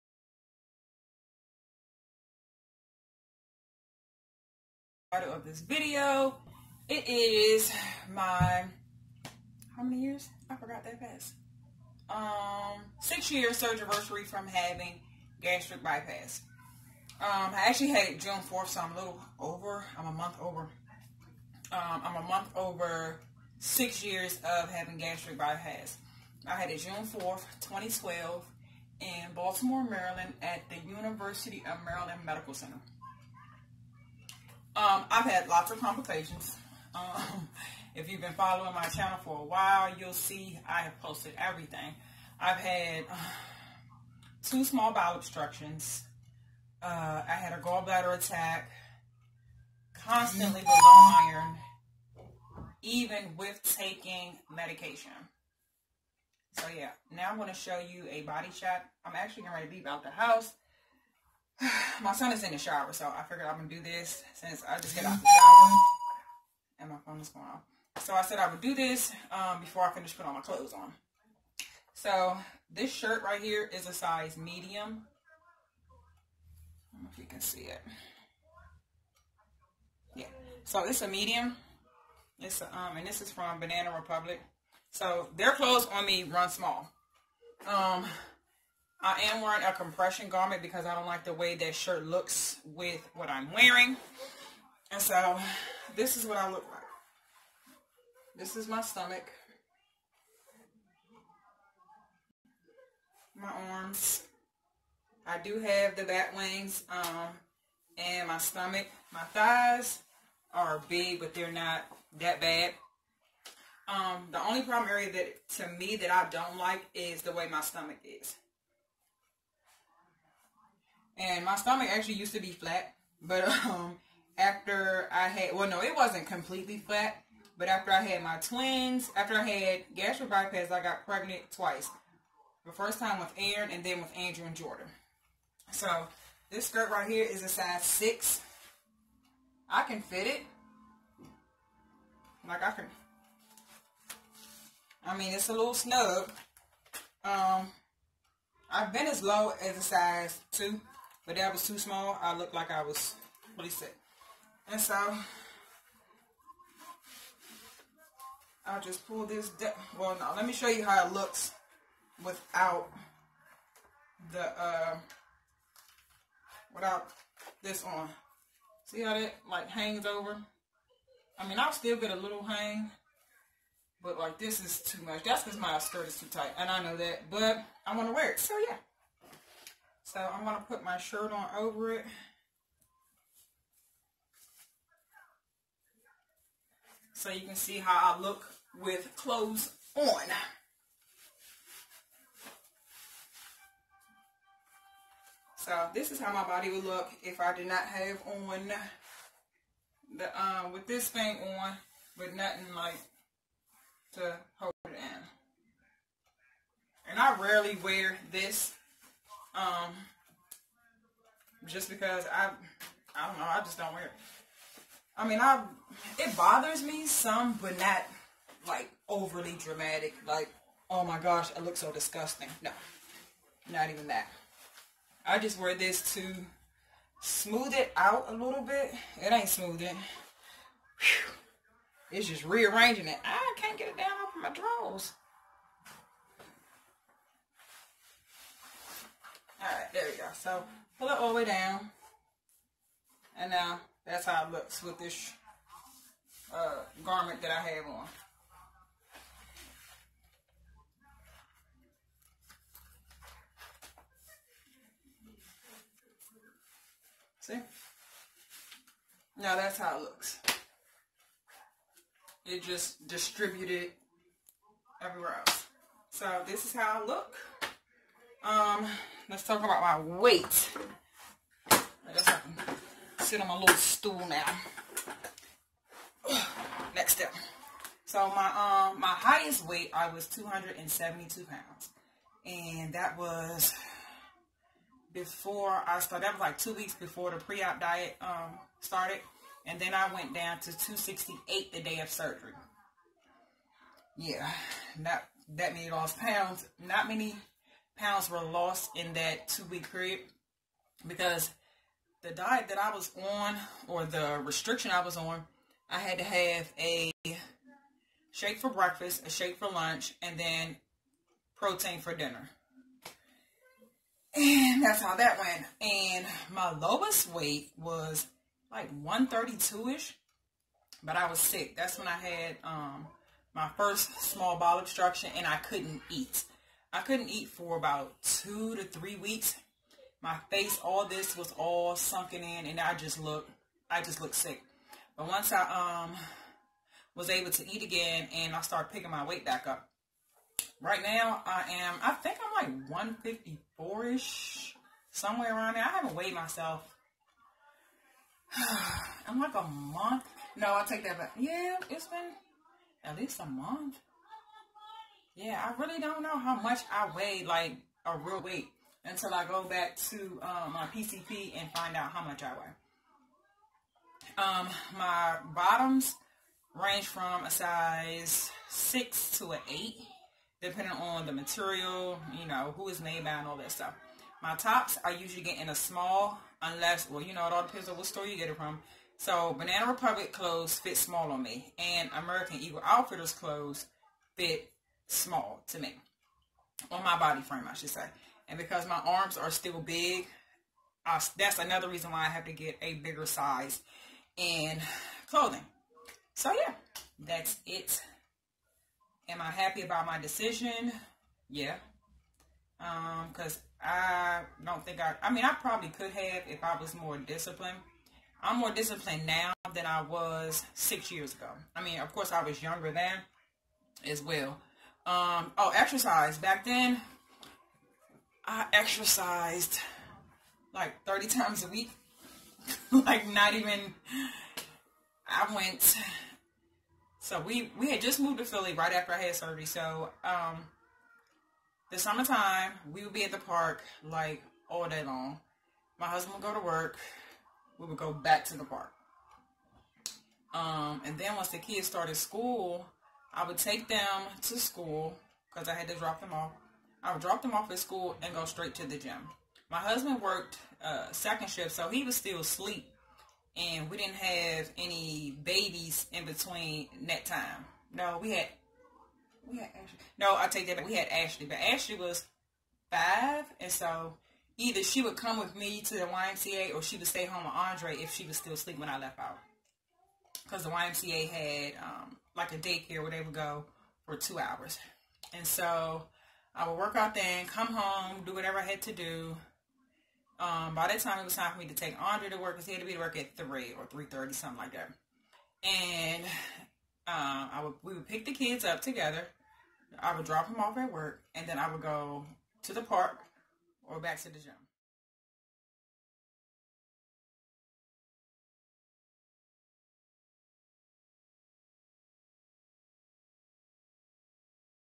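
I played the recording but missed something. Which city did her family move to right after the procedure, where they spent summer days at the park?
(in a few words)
Philly.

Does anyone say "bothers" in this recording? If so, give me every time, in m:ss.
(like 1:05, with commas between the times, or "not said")
3:36.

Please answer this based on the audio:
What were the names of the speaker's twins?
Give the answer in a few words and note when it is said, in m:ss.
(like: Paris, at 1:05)
Andrew and Jordan, at 2:14.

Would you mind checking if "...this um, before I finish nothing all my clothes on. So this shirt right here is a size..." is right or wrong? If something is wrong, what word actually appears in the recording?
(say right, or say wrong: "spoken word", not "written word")
wrong: "putting", not "nothing".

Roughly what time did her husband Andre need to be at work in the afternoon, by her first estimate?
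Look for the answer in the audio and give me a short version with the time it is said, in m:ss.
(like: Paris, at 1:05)
3, at 8:03.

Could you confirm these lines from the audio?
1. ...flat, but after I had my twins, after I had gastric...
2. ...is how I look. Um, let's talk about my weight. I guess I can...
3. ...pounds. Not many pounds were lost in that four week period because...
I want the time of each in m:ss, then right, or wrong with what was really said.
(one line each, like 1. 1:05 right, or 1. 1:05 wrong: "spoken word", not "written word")
1. 2:06 right
2. 4:26 right
3. 4:56 wrong: "two", not "four".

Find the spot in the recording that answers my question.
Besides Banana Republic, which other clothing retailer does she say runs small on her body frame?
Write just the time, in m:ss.
6:22.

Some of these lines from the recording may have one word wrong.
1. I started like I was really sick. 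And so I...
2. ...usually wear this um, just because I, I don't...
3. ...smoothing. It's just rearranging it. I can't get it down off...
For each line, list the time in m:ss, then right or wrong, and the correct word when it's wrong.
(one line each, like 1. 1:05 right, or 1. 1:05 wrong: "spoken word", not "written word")
1. 2:32 wrong: "looked", not "started"
2. 3:27 wrong: "rarely", not "usually"
3. 3:49 right.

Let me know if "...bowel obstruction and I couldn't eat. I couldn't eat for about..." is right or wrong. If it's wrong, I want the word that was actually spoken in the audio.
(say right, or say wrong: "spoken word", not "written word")
right.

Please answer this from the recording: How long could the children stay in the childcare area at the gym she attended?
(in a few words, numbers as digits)
2 hours.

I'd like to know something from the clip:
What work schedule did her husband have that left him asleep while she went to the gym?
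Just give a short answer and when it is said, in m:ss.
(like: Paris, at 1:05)
Second shift, at 7:31.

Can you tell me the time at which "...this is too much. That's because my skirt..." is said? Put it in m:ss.
2:54.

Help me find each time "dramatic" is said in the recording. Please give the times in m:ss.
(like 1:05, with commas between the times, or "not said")
3:39.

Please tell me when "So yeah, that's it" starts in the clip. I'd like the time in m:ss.
6:36.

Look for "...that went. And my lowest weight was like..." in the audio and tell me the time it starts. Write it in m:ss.
5:15.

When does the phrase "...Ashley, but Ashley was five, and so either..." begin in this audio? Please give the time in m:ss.
7:41.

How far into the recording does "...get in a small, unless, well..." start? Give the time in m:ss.
6:15.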